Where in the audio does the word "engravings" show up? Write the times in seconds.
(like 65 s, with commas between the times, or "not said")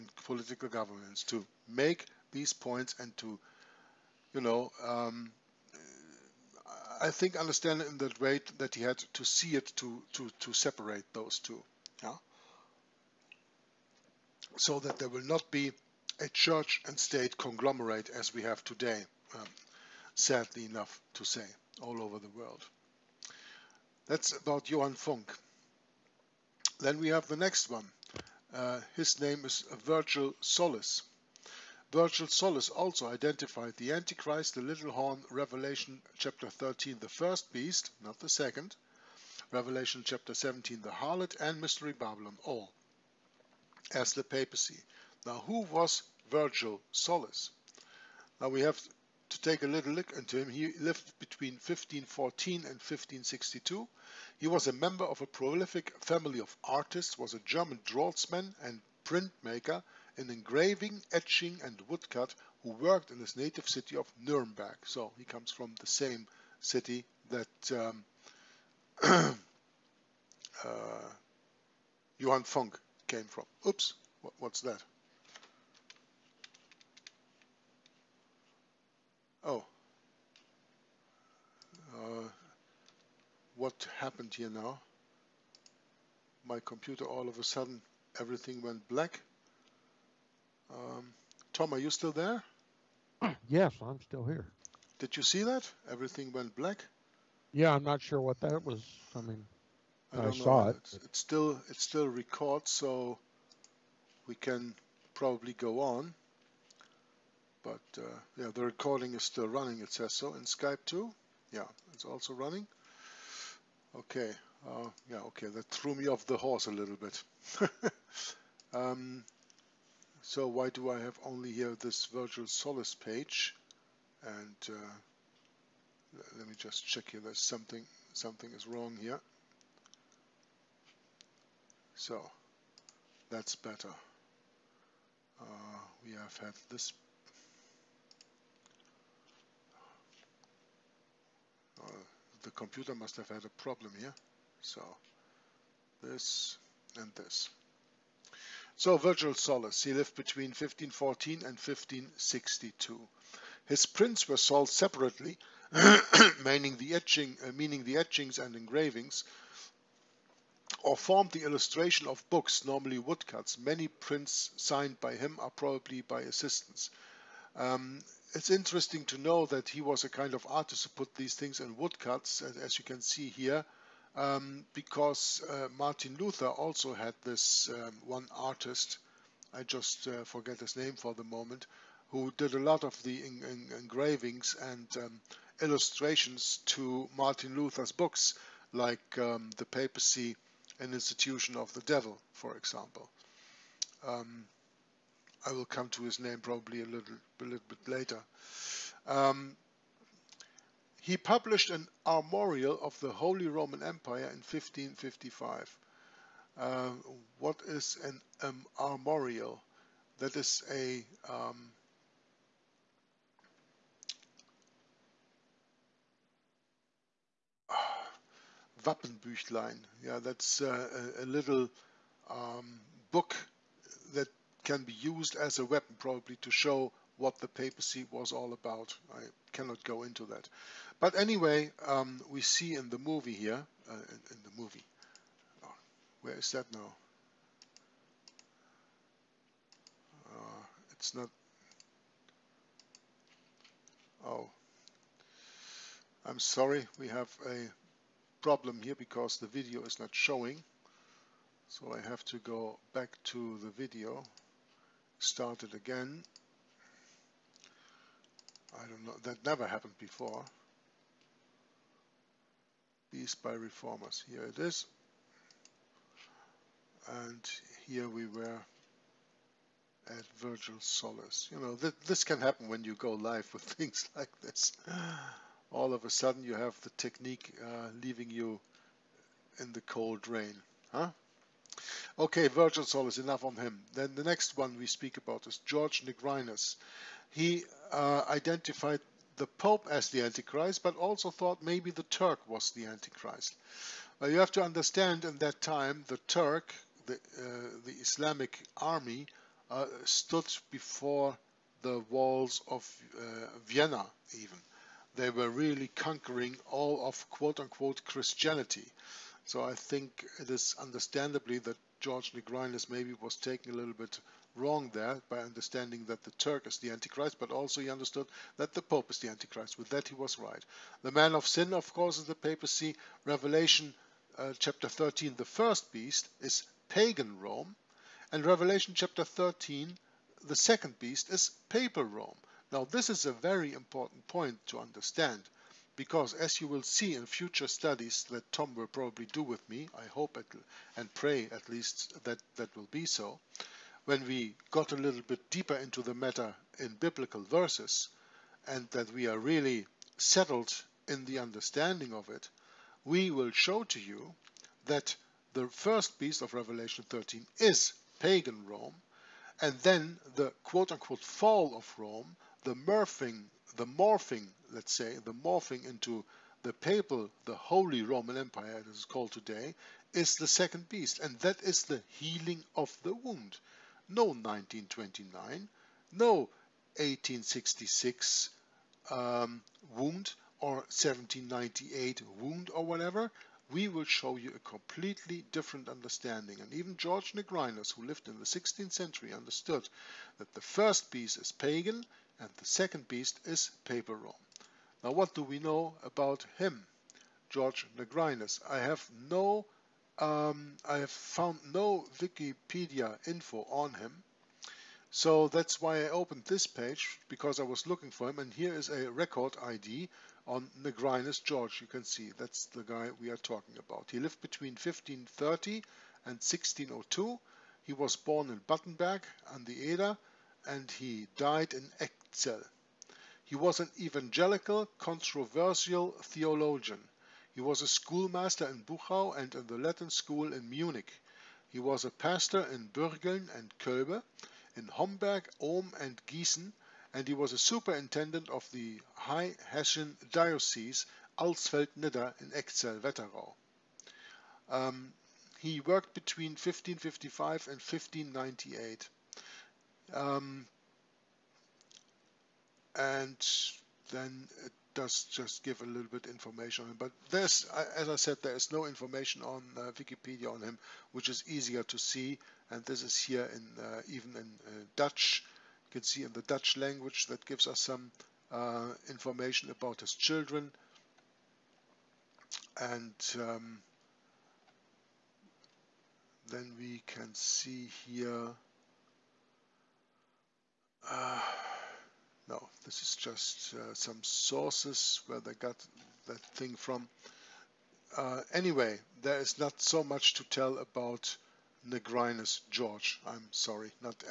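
60 s, 158 s, 183 s.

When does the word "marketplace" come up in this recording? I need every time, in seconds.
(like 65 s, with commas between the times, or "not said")
not said.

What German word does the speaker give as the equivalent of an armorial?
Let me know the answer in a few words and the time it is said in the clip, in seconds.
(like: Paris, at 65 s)
Wappenbüchlein, at 218 s.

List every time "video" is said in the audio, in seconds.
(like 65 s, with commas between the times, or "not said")
249 s, 253 s.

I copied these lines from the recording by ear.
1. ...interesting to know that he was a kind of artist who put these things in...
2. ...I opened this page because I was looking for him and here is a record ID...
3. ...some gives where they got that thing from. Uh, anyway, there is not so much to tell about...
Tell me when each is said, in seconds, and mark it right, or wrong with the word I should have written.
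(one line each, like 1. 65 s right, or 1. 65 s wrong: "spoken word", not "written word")
1. 168 s right
2. 406 s right
3. 483 s wrong: "sources", not "gives".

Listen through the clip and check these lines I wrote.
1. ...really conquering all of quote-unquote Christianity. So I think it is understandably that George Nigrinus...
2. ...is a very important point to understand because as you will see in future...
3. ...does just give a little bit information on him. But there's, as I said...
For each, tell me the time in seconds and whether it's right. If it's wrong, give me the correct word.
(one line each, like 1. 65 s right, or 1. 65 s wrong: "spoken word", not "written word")
1. 305 s right
2. 333 s right
3. 454 s right.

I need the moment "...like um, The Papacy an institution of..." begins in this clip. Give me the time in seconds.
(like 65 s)
188 s.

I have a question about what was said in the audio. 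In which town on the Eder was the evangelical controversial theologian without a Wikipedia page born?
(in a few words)
Battenberg.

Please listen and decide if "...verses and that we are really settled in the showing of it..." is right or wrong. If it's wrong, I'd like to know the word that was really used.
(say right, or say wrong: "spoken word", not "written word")
wrong: "understanding", not "showing".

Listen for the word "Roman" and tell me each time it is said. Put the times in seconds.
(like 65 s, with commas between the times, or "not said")
203 s, 368 s.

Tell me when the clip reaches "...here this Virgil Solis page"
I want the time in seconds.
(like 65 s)
121 s.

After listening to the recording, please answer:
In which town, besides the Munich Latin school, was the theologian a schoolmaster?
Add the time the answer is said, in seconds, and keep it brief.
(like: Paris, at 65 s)
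Buchau, at 428 s.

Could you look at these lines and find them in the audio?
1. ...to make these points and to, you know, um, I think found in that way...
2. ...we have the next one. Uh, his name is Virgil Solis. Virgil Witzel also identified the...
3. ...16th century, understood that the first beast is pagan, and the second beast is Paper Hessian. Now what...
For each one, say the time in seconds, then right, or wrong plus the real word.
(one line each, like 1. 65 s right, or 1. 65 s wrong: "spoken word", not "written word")
1. 1 s wrong: "understand", not "found"
2. 26 s wrong: "Solis", not "Witzel"
3. 388 s wrong: "Rome", not "Hessian".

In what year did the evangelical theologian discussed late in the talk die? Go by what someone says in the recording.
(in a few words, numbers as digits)
1602.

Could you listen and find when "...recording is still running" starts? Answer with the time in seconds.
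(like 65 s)
108 s.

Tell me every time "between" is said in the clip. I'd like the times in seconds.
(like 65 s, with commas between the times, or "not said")
51 s, 150 s, 414 s, 446 s.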